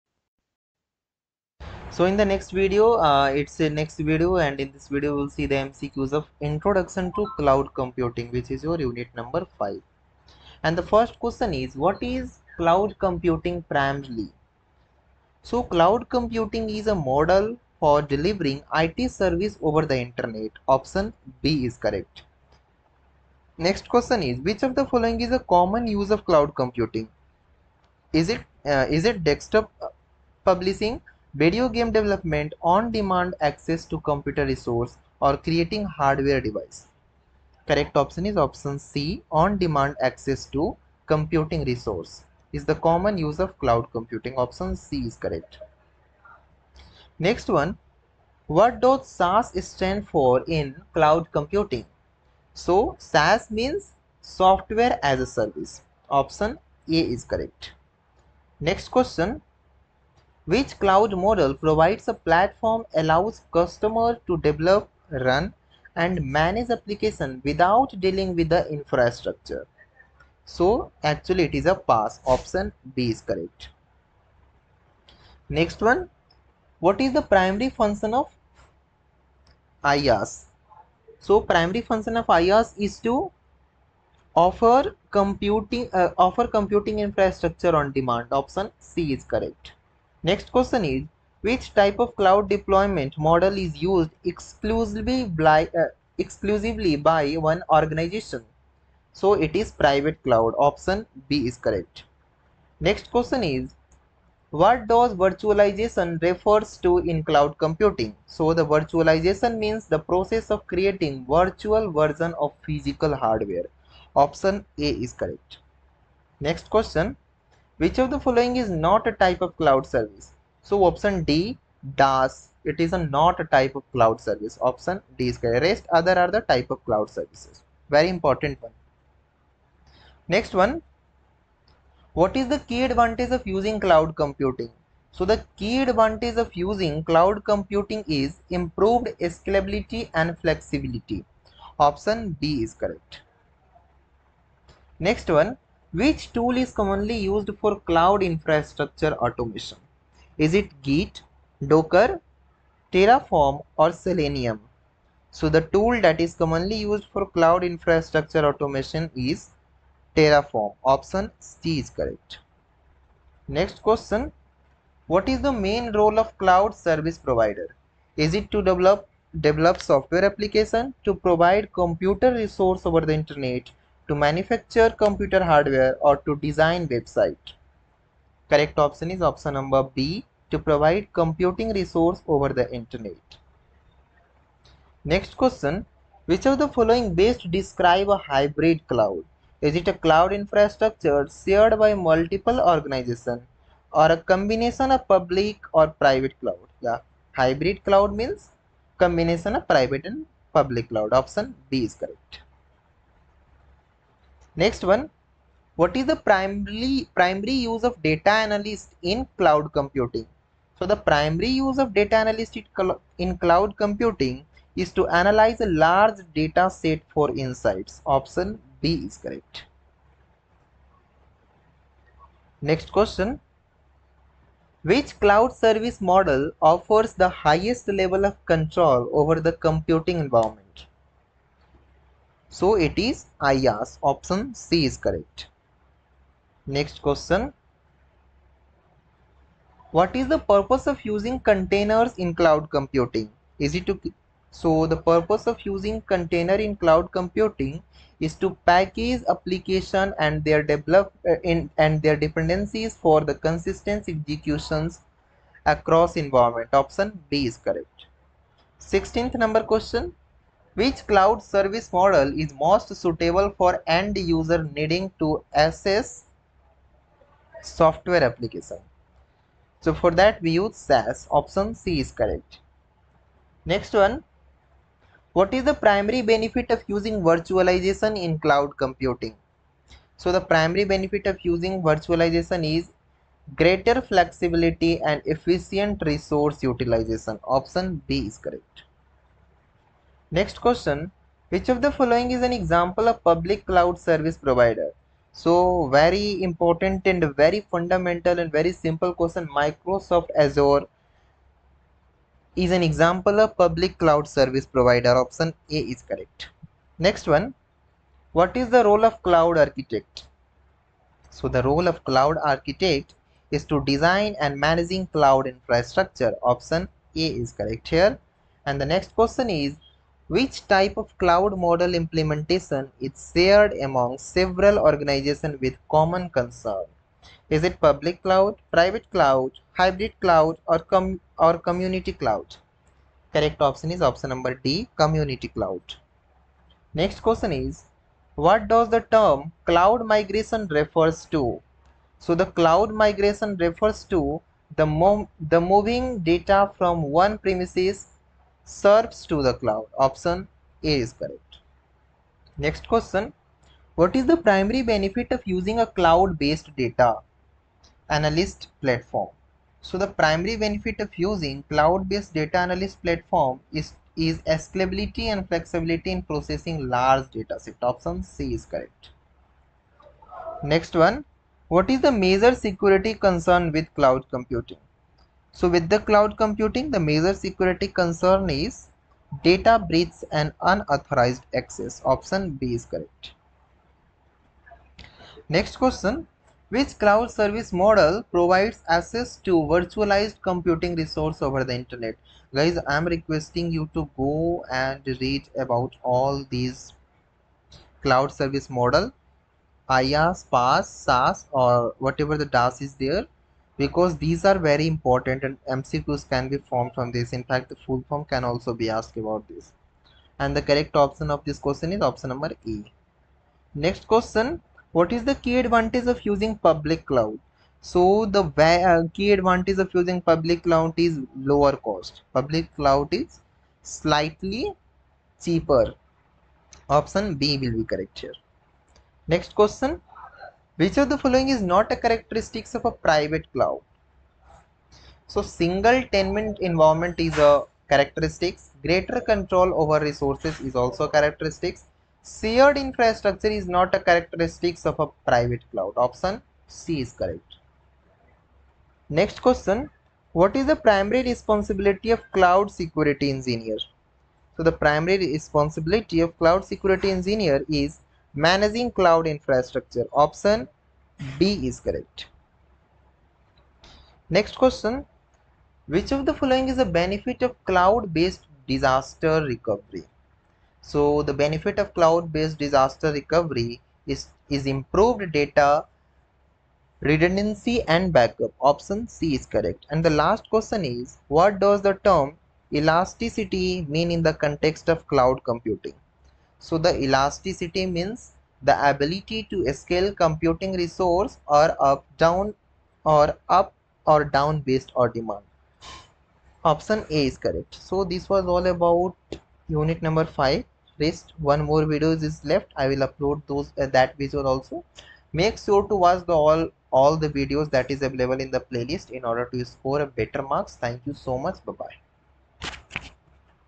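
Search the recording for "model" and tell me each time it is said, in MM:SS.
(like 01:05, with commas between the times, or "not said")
00:17, 01:01, 01:33, 03:46, 04:21, 05:21, 06:27, 06:38.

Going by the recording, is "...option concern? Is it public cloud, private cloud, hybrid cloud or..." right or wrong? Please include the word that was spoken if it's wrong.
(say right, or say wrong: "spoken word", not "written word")
wrong: "common", not "option".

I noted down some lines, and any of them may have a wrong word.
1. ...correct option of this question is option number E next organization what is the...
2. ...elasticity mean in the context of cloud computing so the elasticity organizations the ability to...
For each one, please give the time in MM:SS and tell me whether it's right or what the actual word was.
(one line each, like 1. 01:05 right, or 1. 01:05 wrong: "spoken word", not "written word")
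1. 06:50 wrong: "question", not "organization"
2. 08:02 wrong: "means", not "organizations".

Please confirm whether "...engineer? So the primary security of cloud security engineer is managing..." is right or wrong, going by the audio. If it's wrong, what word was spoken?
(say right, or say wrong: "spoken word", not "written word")
wrong: "responsibility", not "security".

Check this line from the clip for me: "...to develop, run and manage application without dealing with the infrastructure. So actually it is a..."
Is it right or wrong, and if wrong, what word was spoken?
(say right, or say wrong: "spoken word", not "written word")
right.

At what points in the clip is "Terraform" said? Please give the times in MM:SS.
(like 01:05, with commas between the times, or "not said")
02:32, 02:40.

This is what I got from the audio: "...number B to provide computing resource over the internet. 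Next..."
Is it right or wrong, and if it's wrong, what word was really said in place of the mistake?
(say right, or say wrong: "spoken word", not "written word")
right.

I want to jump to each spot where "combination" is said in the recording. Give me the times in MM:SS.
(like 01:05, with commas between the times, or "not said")
03:14, 03:18.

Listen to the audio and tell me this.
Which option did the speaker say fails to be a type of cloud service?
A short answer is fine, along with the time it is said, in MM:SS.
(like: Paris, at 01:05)
DAS, at 02:01.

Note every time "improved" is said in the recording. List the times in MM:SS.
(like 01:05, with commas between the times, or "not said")
02:18, 07:54.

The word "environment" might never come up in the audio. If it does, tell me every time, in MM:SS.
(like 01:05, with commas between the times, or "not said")
03:50, 04:16, 07:16.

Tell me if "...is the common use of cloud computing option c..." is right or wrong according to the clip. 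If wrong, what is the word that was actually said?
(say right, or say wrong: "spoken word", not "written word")
right.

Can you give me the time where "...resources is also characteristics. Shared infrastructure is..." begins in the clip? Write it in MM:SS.
07:20.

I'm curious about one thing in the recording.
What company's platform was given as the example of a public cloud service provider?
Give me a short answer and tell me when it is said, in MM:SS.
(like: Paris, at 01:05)
Microsoft Azure, at 04:59.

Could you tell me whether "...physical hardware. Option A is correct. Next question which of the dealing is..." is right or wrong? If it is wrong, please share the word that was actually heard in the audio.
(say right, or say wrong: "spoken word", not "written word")
wrong: "following", not "dealing".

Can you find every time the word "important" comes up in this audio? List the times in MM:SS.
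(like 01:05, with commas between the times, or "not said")
02:08, 04:56, 06:44.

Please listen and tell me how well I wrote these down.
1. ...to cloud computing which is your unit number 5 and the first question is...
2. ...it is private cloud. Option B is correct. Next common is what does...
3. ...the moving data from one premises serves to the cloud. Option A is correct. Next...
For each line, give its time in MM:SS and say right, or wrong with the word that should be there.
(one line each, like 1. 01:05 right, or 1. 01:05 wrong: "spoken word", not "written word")
1. 00:07 right
2. 01:39 wrong: "question", not "common"
3. 05:45 right.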